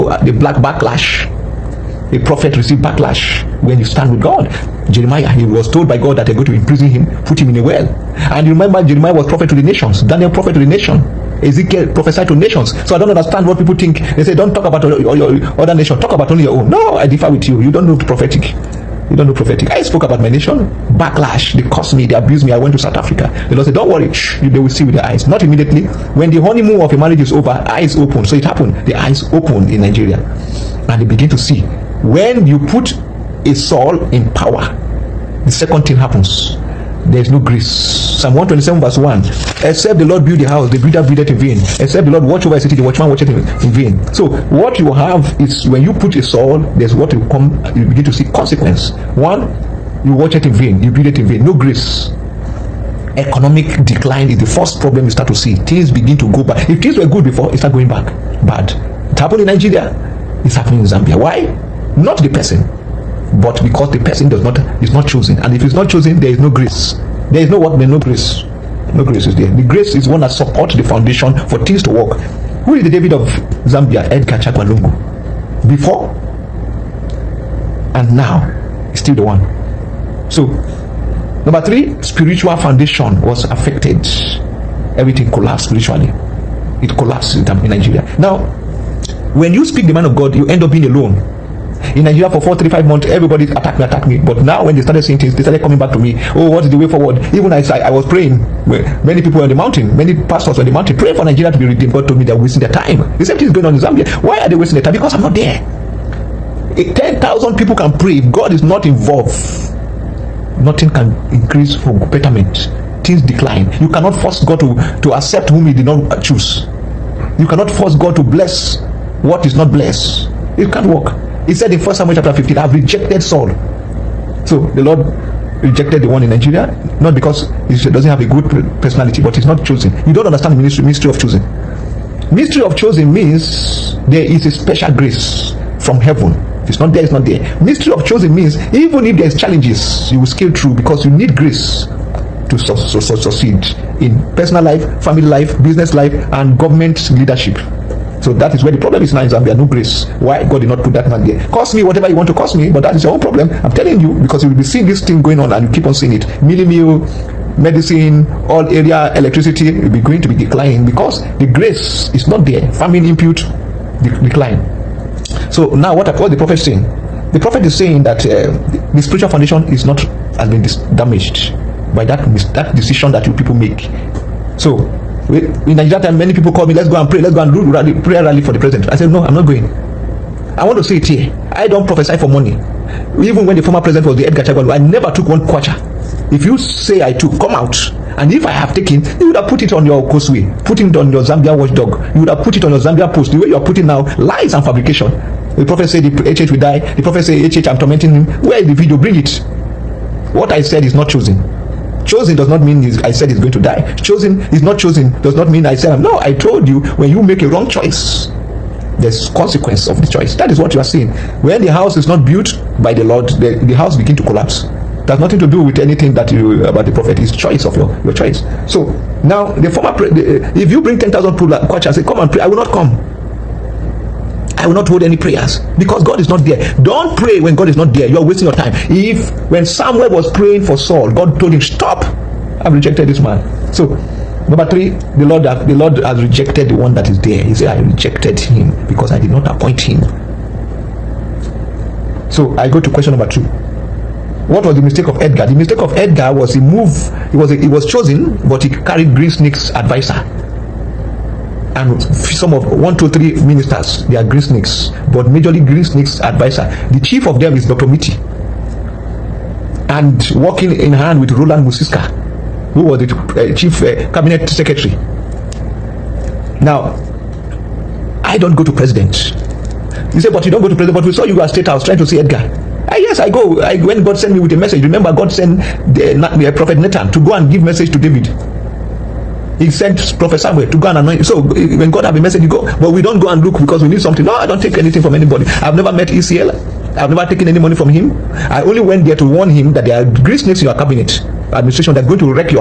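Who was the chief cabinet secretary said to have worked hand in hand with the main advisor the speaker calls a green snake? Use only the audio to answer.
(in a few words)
Roland Musiska.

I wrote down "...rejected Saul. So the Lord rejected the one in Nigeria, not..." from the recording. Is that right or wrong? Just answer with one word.
right.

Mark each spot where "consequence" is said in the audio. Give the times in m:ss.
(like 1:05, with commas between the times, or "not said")
0:48, 3:29.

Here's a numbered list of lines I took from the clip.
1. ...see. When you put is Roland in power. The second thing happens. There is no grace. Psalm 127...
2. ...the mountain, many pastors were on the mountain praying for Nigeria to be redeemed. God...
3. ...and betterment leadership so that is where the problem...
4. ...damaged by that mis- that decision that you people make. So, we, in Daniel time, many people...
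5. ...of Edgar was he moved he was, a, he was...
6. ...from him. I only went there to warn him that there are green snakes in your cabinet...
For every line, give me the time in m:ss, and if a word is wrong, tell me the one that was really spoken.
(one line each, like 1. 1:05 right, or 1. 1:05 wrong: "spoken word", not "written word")
1. 0:31 wrong: "Saul", not "Roland"
2. 1:39 right
3. 2:26 wrong: "government", not "betterment"
4. 2:50 wrong: "Nigeria", not "Daniel"
5. 4:05 right
6. 4:47 right.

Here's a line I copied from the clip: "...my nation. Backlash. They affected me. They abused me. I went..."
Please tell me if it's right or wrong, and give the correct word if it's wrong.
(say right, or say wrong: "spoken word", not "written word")
wrong: "cursed", not "affected".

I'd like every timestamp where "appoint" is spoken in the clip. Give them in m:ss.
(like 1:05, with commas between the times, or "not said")
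3:59.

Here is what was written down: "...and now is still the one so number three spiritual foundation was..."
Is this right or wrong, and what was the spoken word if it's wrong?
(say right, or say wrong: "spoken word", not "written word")
right.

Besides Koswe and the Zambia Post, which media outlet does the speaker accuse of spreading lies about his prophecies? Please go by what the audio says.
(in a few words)
Zambia Watchdog.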